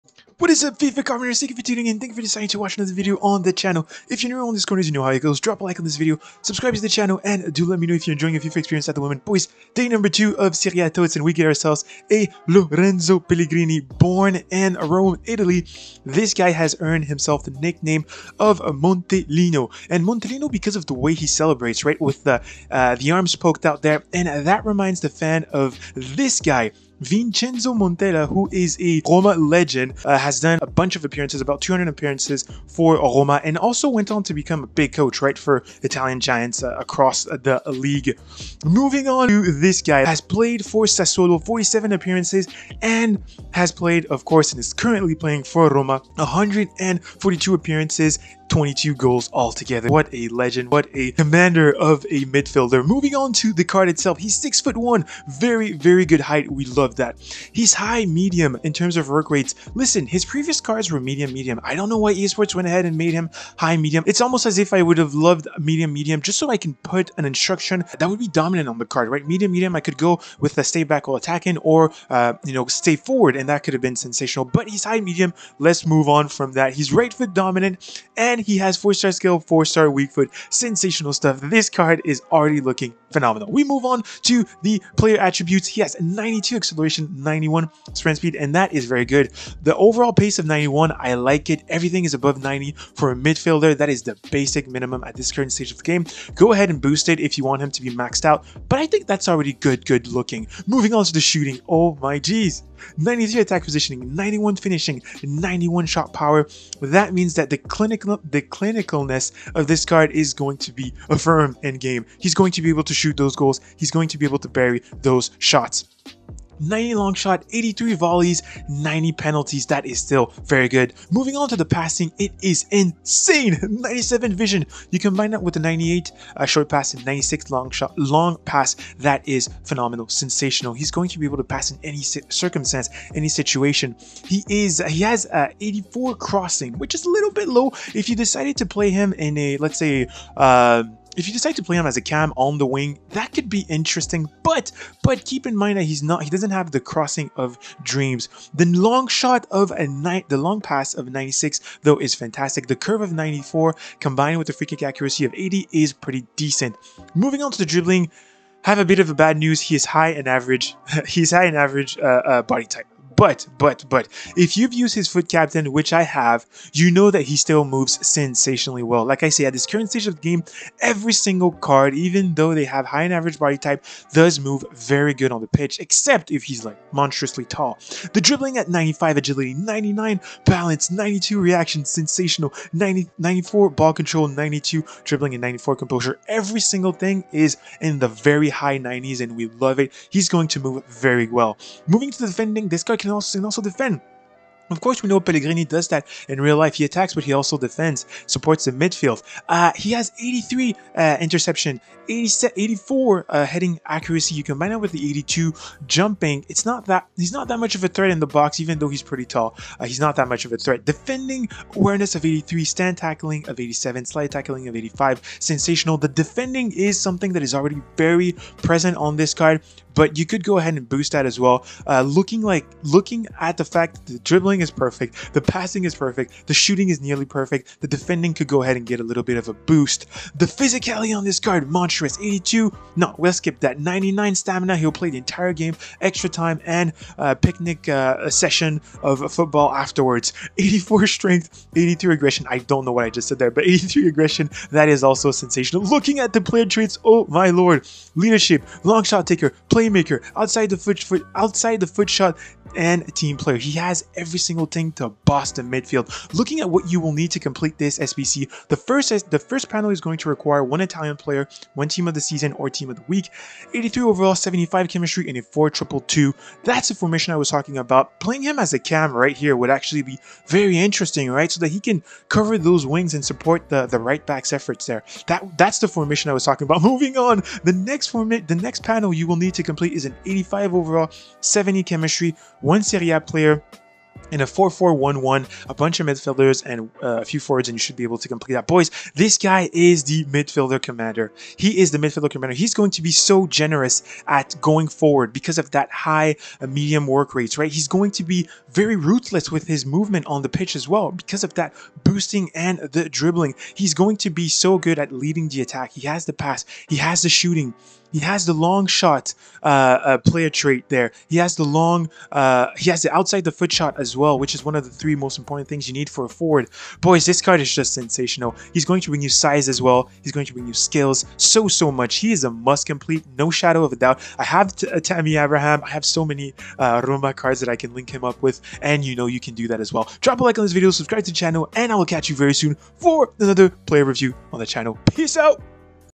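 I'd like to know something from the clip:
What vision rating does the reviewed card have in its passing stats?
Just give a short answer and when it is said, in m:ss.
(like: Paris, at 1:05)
97, at 2:03.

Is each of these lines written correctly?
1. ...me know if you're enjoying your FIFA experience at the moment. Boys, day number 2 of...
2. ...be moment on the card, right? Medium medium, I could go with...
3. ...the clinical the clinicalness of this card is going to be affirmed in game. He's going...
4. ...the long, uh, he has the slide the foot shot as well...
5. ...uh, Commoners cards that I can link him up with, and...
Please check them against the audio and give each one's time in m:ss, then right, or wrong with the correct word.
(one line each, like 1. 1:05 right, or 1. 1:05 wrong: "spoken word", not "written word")
1. 0:07 right
2. 1:08 wrong: "dominant", not "moment"
3. 1:47 right
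4. 5:11 wrong: "outside", not "slide"
5. 5:26 wrong: "Roma", not "Commoners".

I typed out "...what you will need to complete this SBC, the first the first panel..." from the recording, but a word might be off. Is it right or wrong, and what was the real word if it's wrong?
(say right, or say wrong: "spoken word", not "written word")
right.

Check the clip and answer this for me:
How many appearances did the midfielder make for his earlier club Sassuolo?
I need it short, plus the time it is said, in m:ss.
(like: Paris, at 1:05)
47, at 0:41.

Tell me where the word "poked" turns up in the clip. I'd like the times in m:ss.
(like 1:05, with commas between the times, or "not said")
0:23.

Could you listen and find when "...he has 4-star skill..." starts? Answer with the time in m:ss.
1:18.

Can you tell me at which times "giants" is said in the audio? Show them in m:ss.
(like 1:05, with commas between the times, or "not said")
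0:36.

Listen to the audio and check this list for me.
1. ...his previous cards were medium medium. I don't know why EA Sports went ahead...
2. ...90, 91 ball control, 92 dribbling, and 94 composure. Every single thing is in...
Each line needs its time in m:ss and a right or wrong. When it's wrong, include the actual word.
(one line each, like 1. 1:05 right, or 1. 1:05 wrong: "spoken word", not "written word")
1. 1:00 right
2. 3:02 wrong: "94", not "91".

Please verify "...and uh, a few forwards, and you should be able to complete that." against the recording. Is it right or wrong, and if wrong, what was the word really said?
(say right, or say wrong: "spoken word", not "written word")
right.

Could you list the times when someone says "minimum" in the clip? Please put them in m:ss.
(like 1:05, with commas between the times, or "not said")
1:34.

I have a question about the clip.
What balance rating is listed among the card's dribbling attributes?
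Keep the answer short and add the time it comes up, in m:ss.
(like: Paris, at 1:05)
99, at 2:59.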